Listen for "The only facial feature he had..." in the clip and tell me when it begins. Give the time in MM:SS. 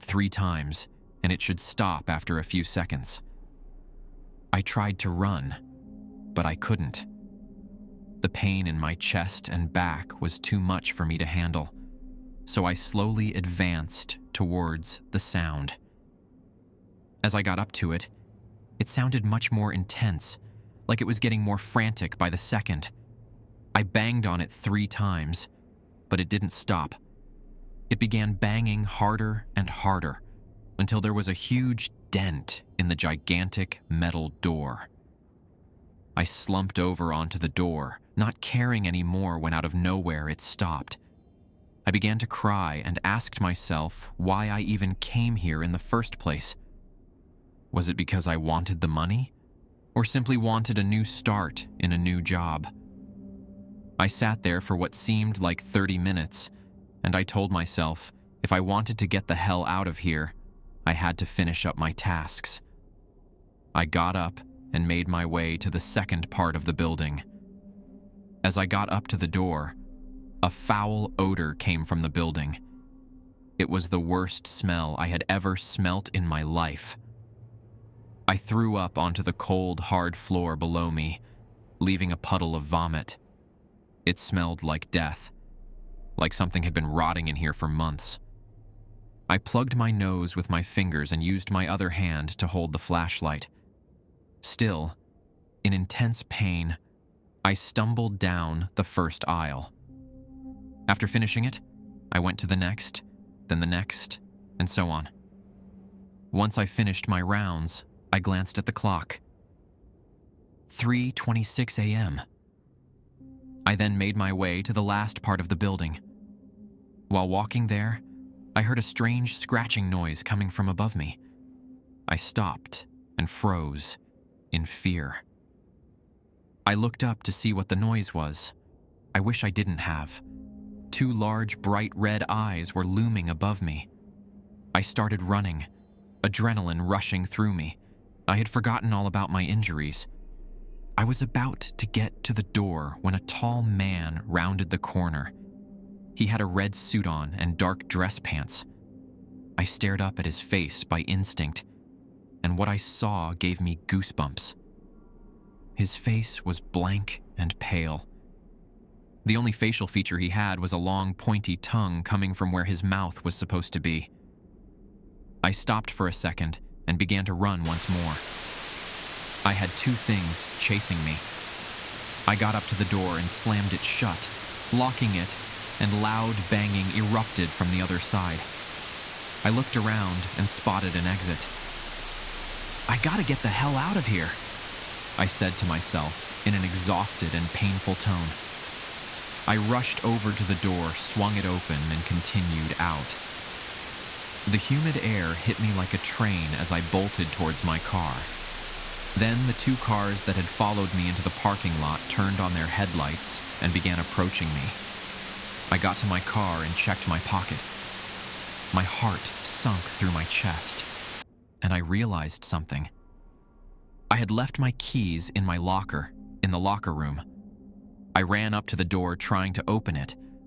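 02:39.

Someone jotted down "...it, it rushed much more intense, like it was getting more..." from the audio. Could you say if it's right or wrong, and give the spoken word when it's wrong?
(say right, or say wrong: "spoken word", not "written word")
wrong: "sounded", not "rushed".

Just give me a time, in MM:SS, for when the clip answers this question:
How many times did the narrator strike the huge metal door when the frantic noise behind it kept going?
00:24.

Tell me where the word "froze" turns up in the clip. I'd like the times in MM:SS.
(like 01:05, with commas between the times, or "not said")
02:03.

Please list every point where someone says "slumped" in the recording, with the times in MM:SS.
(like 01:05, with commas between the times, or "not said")
00:36.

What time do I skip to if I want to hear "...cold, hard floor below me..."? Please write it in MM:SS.
01:19.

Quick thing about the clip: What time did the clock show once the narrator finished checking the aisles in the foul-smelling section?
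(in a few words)
3:26 a.m.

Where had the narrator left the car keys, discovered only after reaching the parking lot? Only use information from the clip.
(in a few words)
In the locker.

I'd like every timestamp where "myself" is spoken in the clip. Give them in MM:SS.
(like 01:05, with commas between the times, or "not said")
00:43, 00:57, 03:05.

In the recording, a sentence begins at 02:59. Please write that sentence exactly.
I looked around and spotted an exit.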